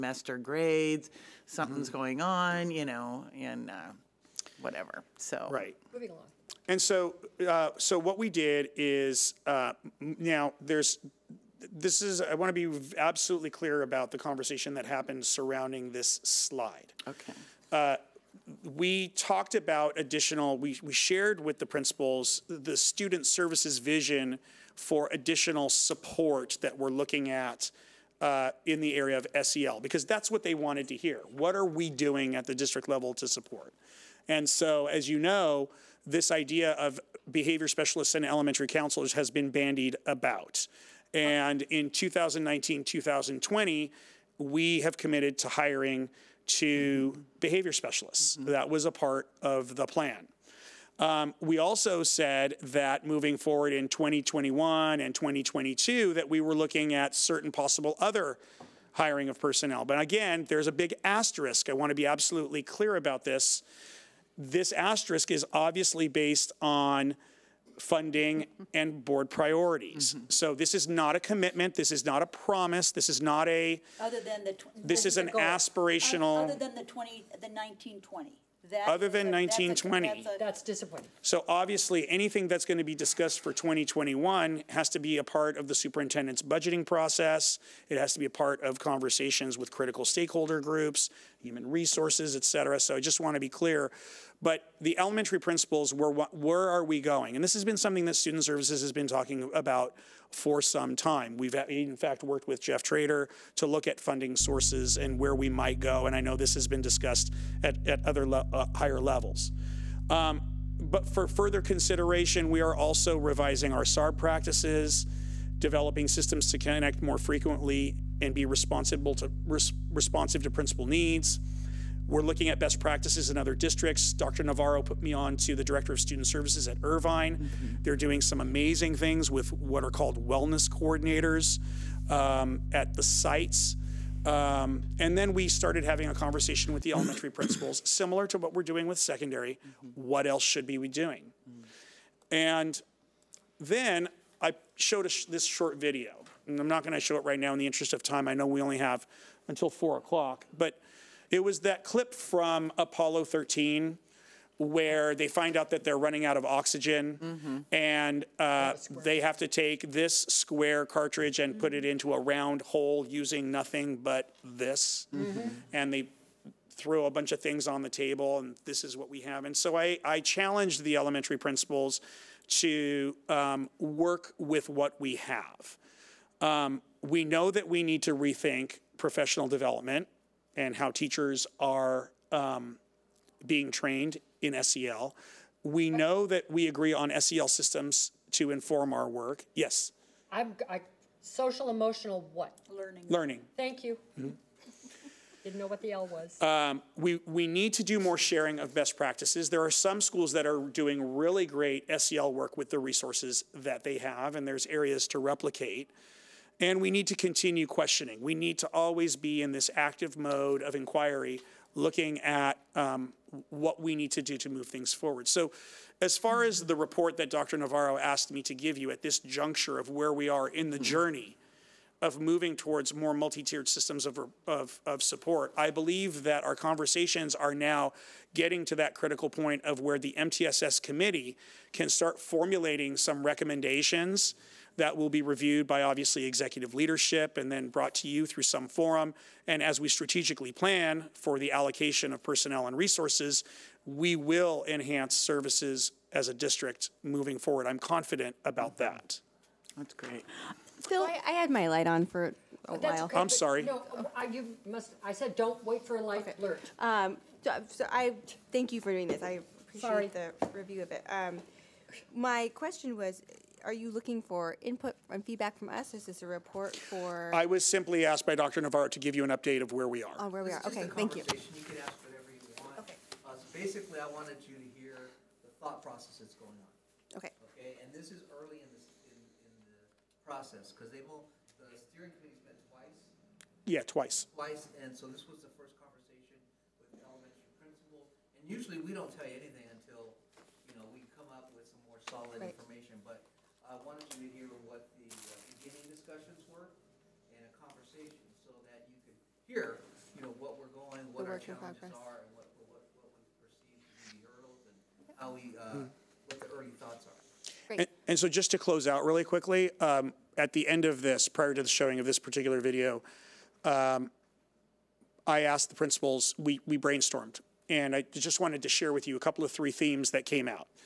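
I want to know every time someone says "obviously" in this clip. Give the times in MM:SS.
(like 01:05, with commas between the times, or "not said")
01:05, 01:21, 03:55.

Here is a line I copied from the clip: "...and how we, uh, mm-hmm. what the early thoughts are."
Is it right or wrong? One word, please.
right.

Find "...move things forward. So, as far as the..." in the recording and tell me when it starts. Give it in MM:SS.
03:34.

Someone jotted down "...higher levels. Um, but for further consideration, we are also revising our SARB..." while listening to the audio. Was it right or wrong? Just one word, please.
right.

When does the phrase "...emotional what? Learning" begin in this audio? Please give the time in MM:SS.
03:11.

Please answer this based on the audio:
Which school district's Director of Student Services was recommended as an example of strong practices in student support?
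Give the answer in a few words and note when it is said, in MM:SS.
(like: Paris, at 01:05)
Irvine, at 02:06.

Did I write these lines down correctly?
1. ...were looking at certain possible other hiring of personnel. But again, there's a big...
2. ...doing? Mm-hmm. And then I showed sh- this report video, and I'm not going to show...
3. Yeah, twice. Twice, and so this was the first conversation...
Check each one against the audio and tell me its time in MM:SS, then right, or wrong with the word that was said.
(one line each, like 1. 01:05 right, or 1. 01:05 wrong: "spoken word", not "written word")
1. 00:56 right
2. 02:20 wrong: "short", not "report"
3. 04:43 right.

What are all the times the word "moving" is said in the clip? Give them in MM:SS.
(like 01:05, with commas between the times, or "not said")
00:05, 00:53, 03:42, 04:07.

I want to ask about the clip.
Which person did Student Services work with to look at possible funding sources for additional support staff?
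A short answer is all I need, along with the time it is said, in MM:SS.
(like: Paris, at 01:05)
Jeff Trader, at 01:42.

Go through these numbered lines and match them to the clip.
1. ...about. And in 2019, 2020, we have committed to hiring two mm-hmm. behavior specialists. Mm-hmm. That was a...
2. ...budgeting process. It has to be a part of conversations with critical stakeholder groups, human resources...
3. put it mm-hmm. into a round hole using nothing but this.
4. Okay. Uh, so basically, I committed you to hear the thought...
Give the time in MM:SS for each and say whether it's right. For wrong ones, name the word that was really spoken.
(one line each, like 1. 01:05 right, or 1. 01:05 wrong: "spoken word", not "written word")
1. 00:40 right
2. 01:26 right
3. 02:41 right
4. 04:32 wrong: "wanted", not "committed".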